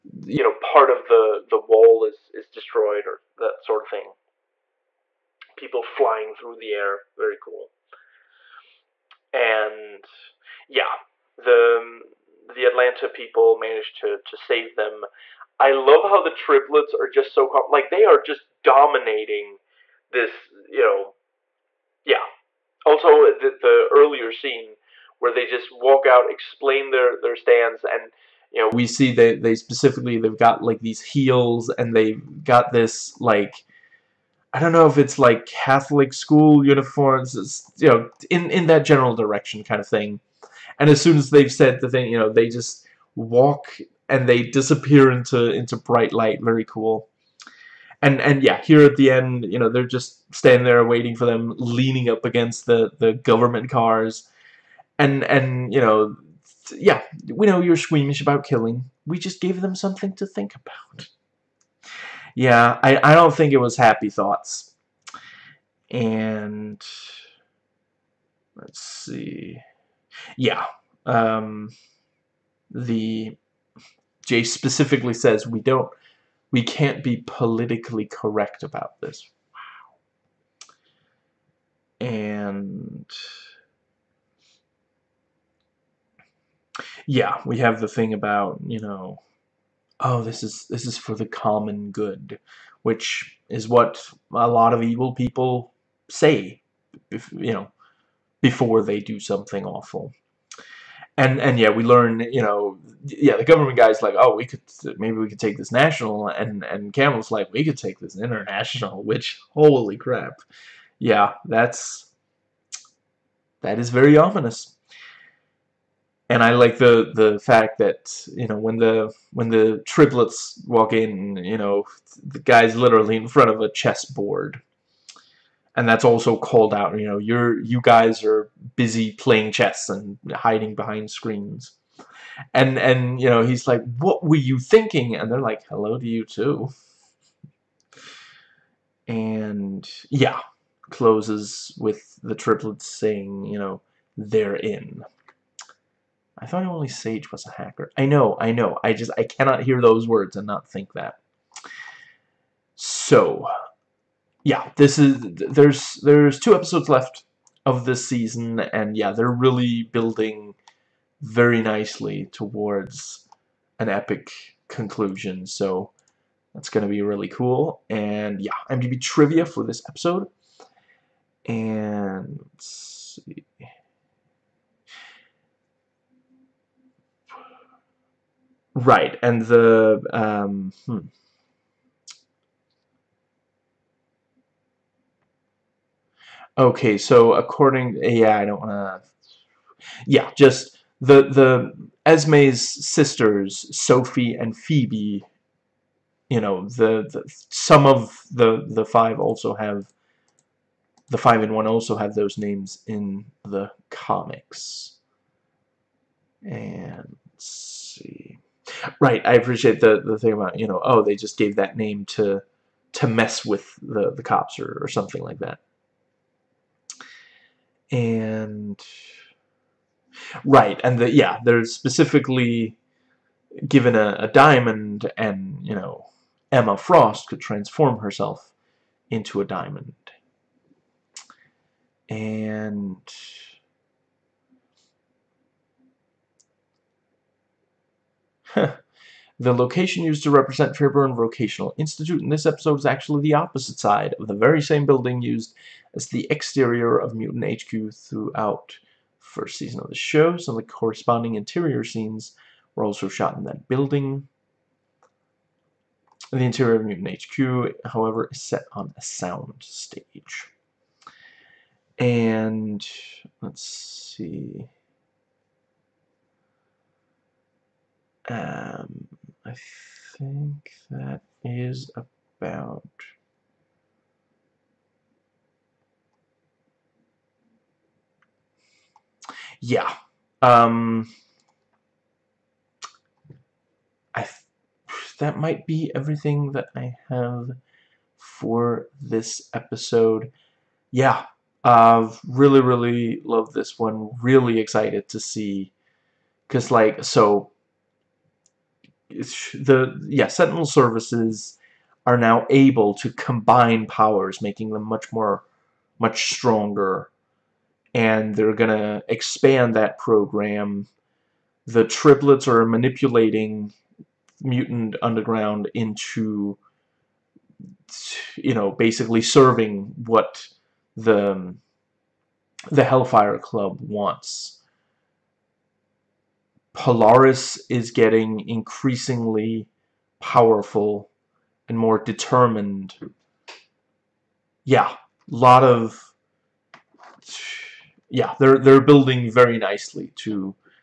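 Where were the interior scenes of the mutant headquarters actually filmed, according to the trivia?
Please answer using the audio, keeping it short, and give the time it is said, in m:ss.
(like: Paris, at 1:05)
A sound stage, at 4:19.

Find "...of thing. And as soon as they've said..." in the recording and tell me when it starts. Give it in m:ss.
0:39.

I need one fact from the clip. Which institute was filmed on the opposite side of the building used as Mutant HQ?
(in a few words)
Fairburn Vocational Institute.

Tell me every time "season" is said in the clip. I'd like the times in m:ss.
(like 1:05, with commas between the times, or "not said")
2:38, 4:09.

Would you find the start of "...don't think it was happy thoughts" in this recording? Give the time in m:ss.
1:03.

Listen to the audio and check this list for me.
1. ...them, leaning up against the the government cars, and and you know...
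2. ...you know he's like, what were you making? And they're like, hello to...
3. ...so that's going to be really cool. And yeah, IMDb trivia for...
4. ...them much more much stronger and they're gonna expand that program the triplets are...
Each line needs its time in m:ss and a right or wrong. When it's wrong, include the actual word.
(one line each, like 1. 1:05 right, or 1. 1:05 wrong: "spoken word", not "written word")
1. 0:51 right
2. 2:13 wrong: "thinking", not "making"
3. 2:45 right
4. 5:04 right.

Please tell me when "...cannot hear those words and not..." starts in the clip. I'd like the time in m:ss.
2:29.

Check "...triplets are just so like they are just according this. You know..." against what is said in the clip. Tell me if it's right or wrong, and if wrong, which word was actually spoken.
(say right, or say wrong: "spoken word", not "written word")
wrong: "dominating", not "according".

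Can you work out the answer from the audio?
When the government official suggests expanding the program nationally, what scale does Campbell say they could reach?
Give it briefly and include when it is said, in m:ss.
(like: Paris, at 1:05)
International, at 1:48.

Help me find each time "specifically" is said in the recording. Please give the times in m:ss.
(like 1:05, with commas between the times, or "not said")
0:29, 1:14, 3:41.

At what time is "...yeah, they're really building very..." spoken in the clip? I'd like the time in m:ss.
2:38.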